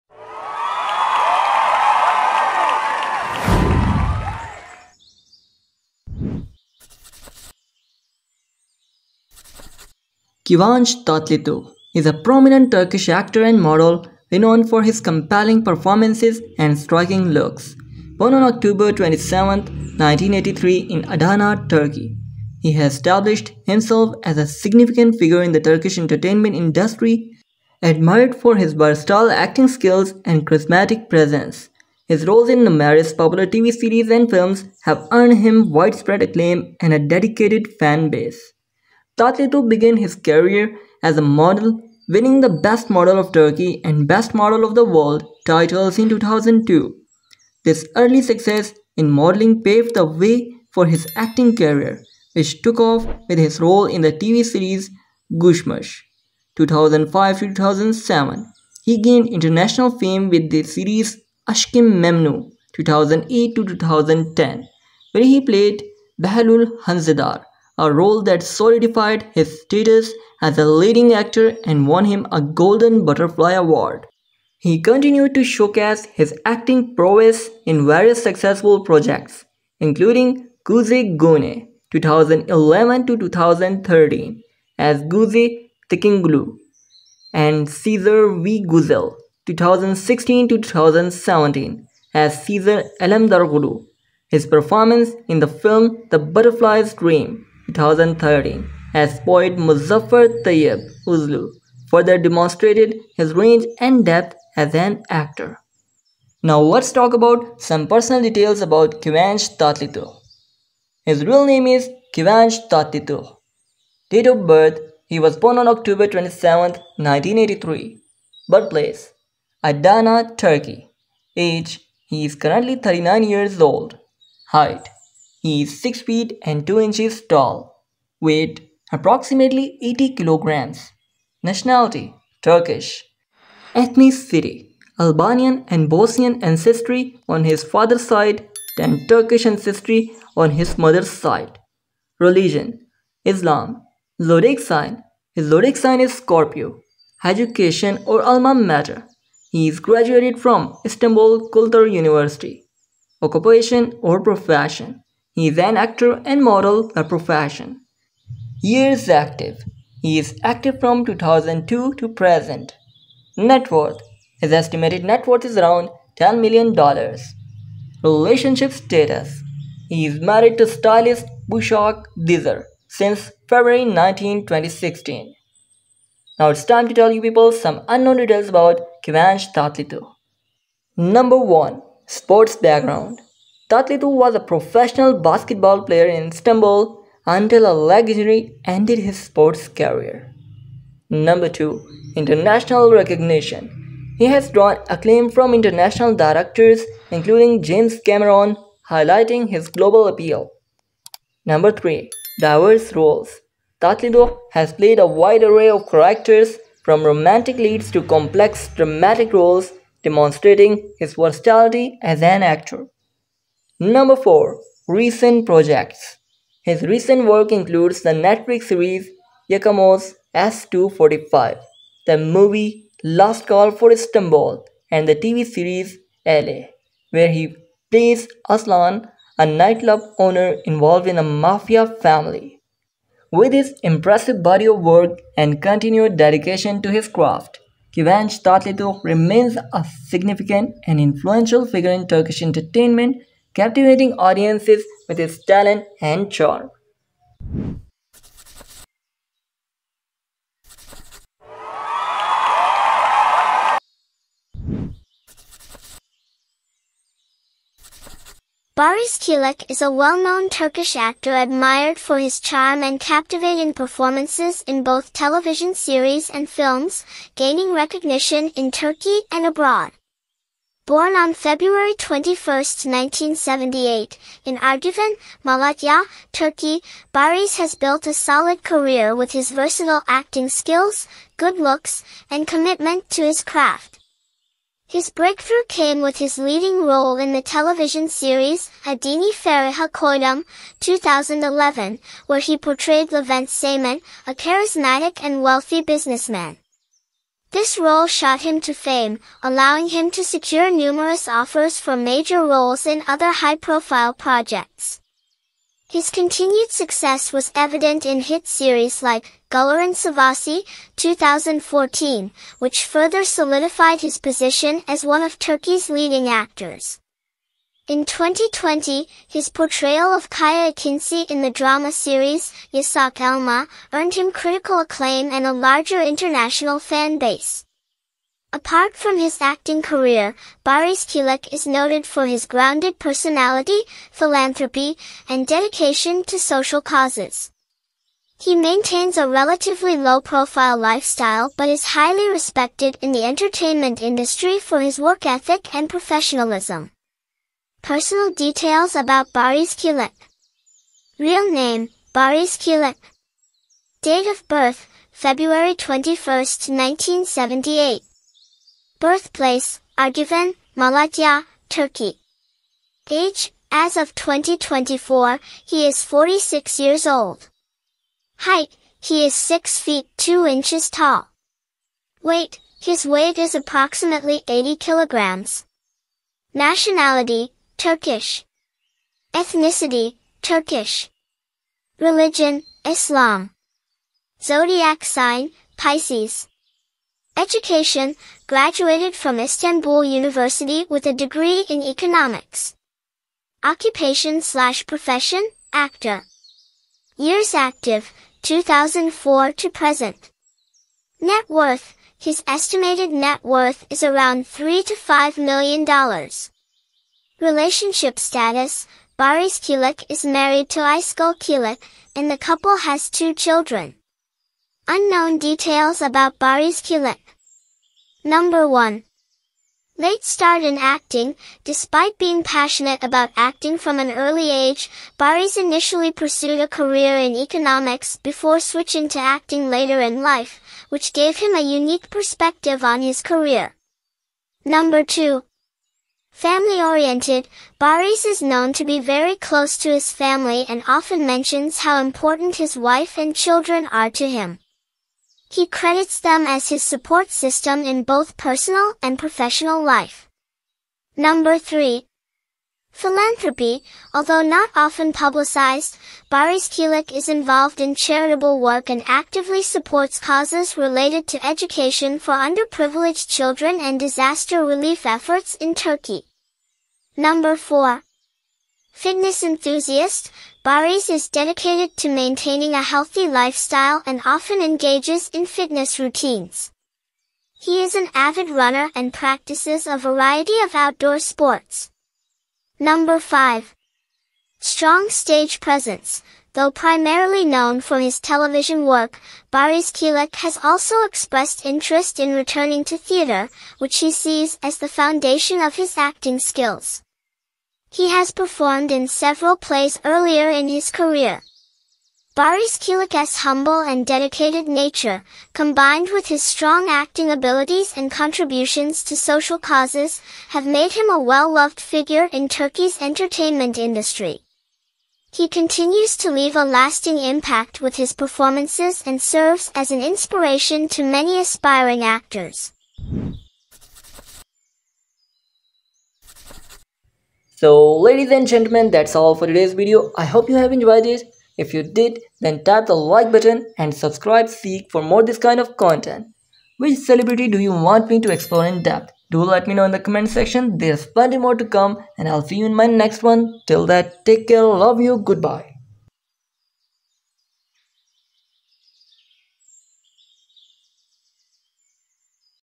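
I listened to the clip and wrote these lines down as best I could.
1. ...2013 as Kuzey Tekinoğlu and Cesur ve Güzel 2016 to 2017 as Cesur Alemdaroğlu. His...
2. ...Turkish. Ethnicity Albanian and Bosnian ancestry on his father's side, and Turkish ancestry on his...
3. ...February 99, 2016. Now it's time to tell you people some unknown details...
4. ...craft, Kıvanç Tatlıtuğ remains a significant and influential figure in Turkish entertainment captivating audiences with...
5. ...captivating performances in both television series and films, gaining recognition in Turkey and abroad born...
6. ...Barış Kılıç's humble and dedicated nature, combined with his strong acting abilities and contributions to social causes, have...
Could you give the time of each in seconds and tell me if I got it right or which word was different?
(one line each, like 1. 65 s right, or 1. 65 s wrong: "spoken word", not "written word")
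1. 83 s right
2. 132 s right
3. 173 s wrong: "19", not "99"
4. 237 s right
5. 262 s right
6. 502 s right.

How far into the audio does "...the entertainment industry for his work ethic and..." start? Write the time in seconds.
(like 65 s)
343 s.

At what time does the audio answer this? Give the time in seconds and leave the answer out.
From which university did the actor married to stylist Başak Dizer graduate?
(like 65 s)
150 s.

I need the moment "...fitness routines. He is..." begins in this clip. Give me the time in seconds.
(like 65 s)
475 s.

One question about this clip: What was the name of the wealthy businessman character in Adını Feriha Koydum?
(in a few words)
Levent Seyman.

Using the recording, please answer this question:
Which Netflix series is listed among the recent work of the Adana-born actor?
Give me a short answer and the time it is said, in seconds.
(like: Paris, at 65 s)
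Yakamoz S-245, at 219 s.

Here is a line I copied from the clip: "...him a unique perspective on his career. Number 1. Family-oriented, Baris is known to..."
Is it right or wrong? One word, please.
wrong.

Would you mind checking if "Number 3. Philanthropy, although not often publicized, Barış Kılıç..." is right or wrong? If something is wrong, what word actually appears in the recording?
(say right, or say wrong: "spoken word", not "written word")
right.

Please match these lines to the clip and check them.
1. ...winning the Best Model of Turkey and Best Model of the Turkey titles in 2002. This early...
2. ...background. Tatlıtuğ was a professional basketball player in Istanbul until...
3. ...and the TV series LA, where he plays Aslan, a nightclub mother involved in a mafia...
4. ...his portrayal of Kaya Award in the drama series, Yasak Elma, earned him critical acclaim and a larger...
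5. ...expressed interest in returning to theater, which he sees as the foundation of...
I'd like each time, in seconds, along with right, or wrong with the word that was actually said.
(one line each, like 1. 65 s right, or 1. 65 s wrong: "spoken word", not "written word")
1. 42 s wrong: "World", not "Turkey"
2. 182 s right
3. 224 s wrong: "owner", not "mother"
4. 319 s wrong: "Kinsey", not "Award"
5. 491 s right.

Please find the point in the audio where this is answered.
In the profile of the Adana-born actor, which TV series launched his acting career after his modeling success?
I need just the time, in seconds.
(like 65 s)
55 s.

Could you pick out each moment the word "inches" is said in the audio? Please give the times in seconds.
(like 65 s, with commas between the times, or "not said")
126 s, 370 s.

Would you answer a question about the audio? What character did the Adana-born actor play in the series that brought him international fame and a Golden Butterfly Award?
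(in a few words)
Behlül Haznedar.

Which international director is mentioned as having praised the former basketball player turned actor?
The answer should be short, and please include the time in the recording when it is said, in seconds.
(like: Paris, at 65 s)
James Cameron, at 197 s.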